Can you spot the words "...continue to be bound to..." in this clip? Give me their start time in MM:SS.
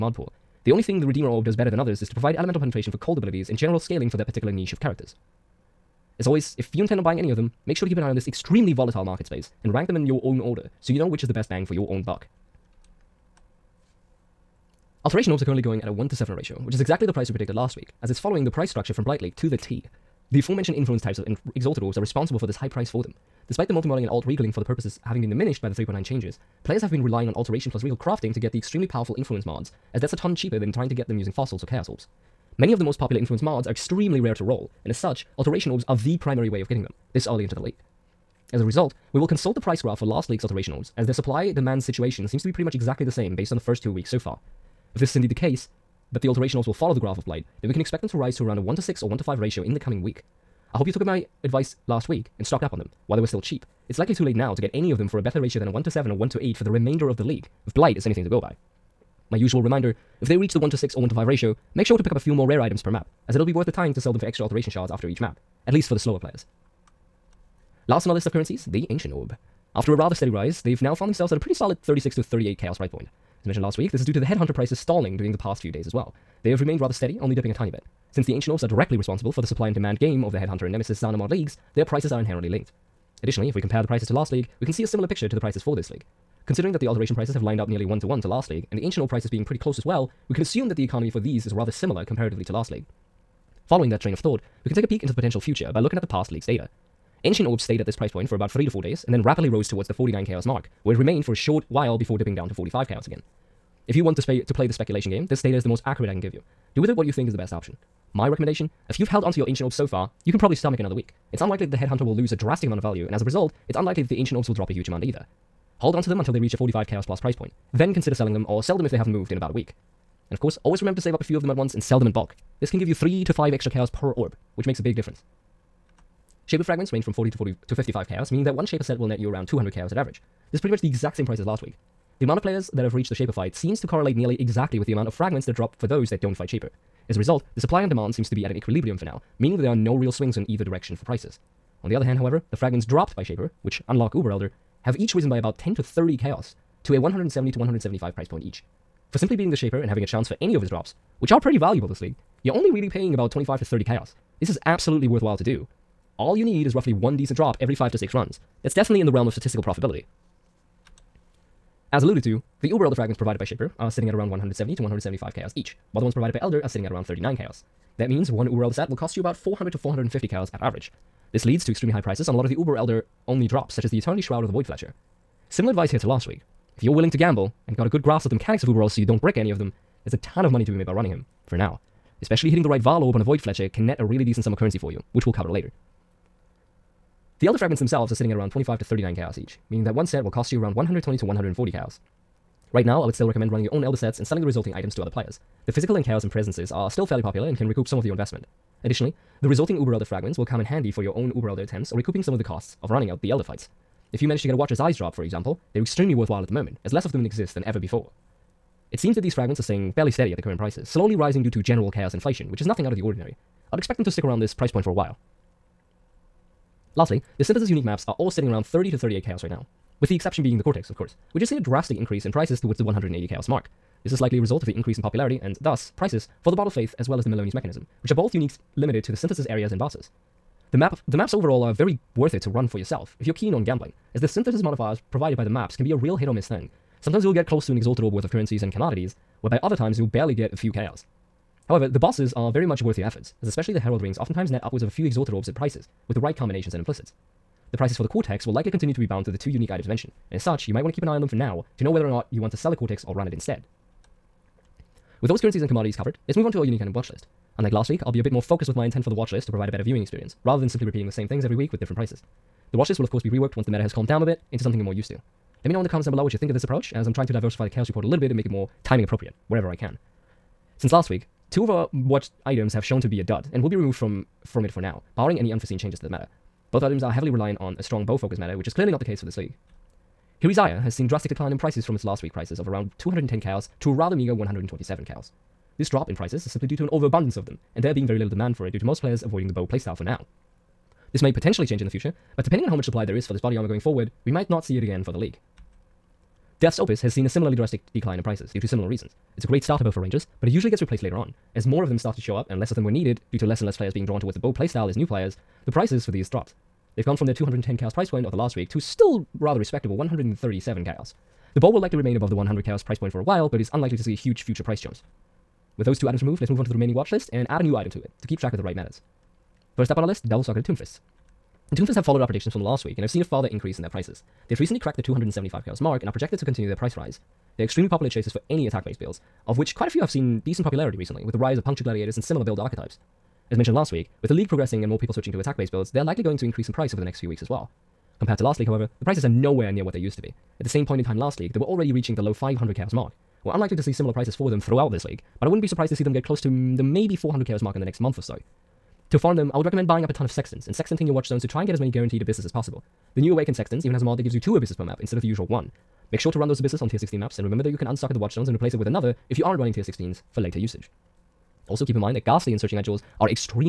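04:08.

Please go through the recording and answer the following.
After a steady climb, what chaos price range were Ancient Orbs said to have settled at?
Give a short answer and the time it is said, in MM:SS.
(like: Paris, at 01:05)
36 to 38 chaos, at 01:11.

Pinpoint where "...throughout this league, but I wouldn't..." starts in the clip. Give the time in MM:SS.
05:44.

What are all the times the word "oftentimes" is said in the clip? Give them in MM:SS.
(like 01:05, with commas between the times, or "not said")
04:04.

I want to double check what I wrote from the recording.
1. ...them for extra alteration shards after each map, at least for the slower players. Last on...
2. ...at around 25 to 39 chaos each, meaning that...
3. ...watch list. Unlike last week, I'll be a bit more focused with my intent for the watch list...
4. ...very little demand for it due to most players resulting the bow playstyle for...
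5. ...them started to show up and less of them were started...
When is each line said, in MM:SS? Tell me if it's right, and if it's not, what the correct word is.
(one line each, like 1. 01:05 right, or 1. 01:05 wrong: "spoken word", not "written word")
1. 01:04 right
2. 03:08 right
3. 04:16 right
4. 04:48 wrong: "avoiding", not "resulting"
5. 05:01 wrong: "needed", not "started".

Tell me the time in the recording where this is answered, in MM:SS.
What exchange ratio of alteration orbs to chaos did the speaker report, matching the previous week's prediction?
00:15.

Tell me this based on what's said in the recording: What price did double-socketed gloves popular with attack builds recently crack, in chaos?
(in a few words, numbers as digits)
275 chaos.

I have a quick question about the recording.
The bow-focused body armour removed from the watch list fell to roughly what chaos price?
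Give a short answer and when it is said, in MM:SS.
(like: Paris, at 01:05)
127 chaos, at 04:44.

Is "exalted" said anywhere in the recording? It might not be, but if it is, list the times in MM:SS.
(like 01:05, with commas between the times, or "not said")
00:21, 03:57, 04:05.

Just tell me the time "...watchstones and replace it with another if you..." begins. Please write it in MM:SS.
05:58.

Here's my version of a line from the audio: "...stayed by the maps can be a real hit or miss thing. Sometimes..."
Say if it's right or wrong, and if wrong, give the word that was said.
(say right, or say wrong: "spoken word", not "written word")
wrong: "provided", not "stayed".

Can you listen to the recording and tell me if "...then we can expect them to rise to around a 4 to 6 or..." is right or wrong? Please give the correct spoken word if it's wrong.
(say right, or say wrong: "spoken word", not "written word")
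wrong: "1", not "4".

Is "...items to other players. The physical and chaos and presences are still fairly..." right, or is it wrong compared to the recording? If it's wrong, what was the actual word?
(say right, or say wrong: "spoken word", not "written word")
right.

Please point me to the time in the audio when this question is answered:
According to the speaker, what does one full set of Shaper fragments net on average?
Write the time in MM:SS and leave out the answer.
02:09.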